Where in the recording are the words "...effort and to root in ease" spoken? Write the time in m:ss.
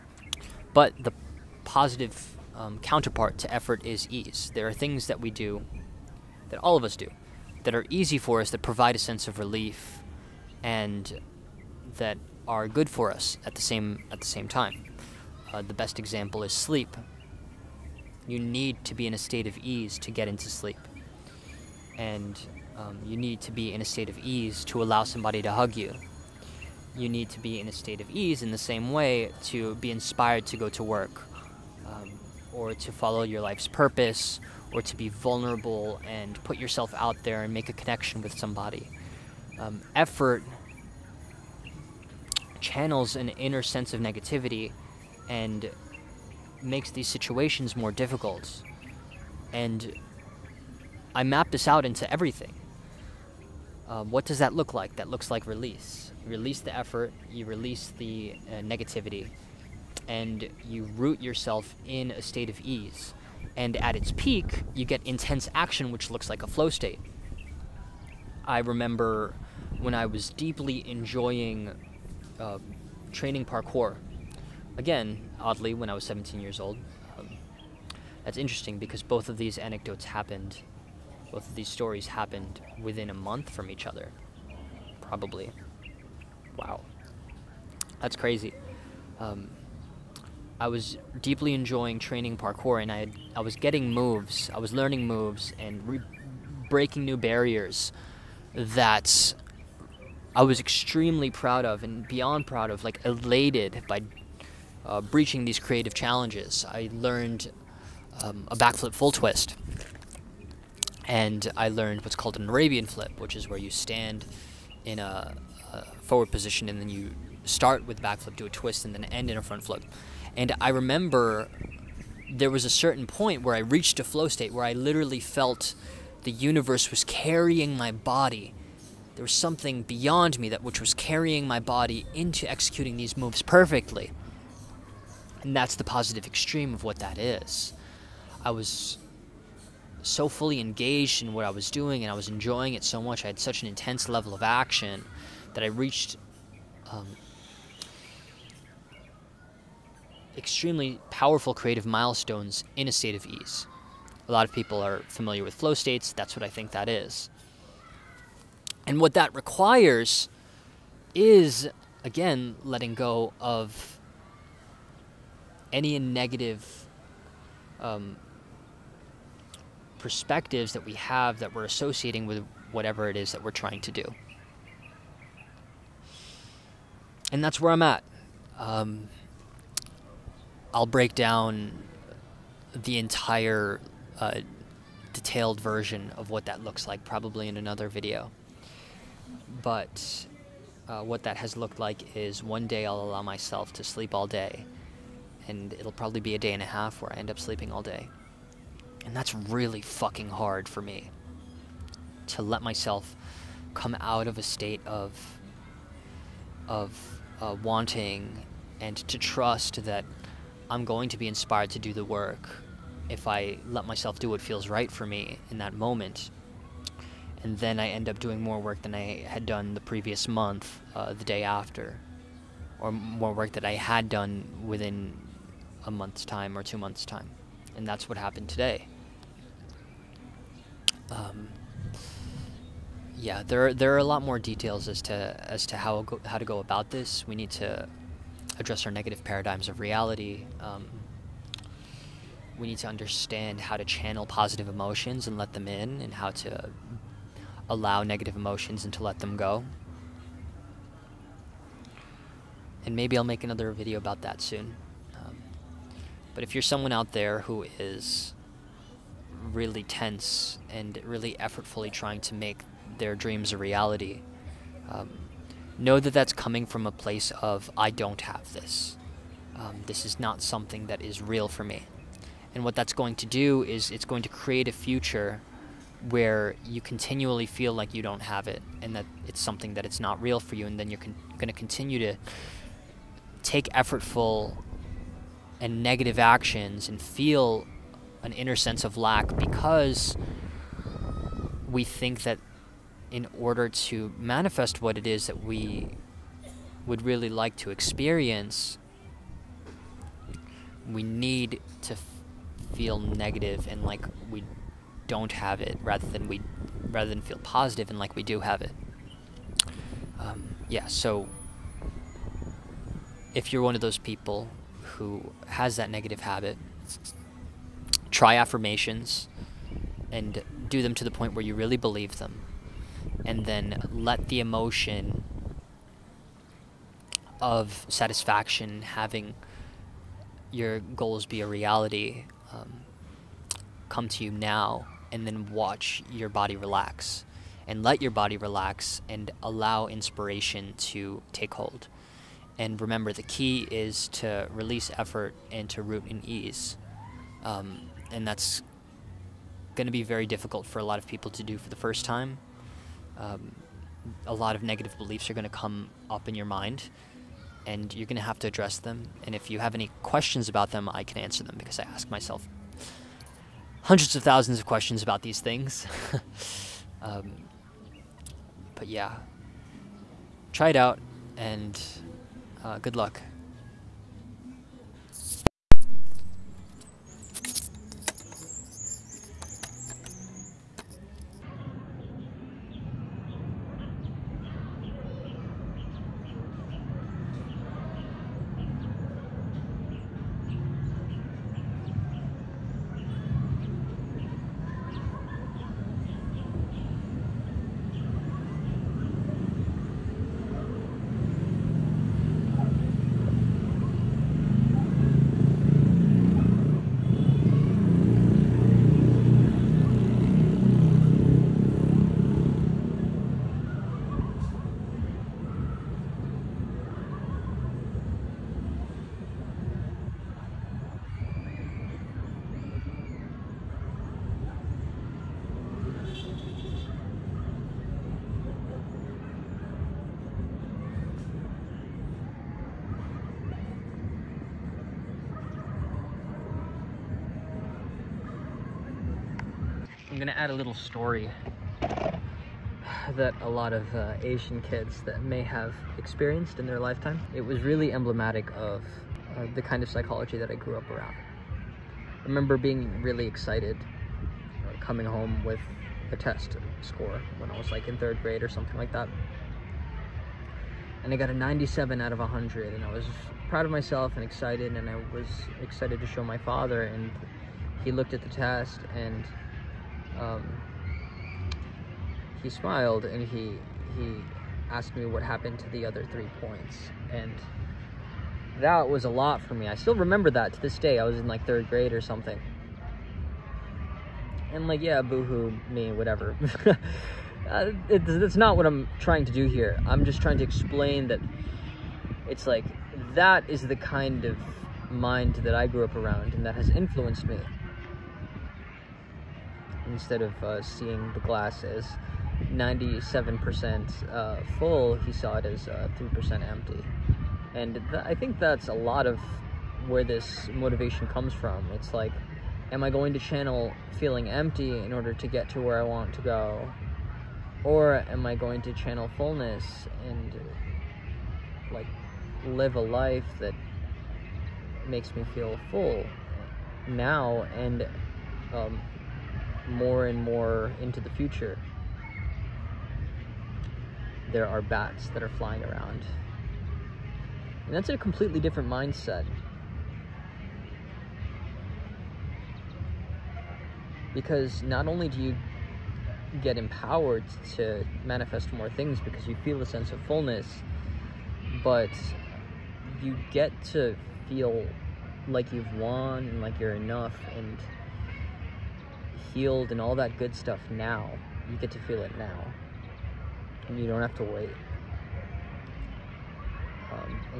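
5:44.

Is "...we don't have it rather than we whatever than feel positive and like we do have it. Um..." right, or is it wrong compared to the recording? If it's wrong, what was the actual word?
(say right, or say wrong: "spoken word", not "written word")
wrong: "rather", not "whatever".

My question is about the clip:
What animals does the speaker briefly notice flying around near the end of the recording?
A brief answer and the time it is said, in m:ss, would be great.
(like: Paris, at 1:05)
bats, at 8:54.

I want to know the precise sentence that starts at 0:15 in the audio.
Uh, the best example is sleep.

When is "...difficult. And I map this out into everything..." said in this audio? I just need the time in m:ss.
0:47.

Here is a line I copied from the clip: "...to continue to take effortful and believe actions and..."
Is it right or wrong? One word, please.
wrong.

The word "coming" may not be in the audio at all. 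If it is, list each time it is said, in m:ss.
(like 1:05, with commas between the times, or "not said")
4:26, 7:34.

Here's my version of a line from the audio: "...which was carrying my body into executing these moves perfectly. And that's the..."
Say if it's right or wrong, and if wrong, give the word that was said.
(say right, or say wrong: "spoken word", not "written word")
right.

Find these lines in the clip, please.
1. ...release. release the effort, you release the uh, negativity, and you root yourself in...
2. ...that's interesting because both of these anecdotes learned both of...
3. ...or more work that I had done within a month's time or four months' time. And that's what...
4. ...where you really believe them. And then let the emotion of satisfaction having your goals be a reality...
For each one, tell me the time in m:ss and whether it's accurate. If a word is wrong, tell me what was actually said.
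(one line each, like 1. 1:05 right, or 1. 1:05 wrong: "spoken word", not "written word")
1. 0:55 right
2. 1:18 wrong: "happened", not "learned"
3. 3:42 wrong: "two", not "four"
4. 5:21 right.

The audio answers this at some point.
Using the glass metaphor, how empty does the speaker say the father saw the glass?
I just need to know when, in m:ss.
8:25.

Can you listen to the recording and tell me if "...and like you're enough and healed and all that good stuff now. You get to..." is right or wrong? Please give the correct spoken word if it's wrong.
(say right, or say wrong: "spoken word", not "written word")
right.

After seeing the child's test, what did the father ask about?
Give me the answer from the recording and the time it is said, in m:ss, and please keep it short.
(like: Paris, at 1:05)
the other three points, at 7:55.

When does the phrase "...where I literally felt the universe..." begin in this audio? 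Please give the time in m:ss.
2:04.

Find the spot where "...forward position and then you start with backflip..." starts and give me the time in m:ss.
1:56.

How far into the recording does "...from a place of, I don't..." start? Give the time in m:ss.
4:26.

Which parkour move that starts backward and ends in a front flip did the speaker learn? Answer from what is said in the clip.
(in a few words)
Arabian flip.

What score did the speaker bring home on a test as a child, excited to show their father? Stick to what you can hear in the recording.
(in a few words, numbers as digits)
97 out of 100.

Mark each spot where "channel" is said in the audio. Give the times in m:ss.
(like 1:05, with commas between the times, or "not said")
0:42, 4:03, 8:33, 8:38.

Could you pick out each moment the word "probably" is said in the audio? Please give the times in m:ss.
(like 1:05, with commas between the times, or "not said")
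1:25, 3:07, 3:15.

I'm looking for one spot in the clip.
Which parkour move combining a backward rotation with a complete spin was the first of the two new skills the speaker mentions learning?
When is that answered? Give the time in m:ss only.
1:48.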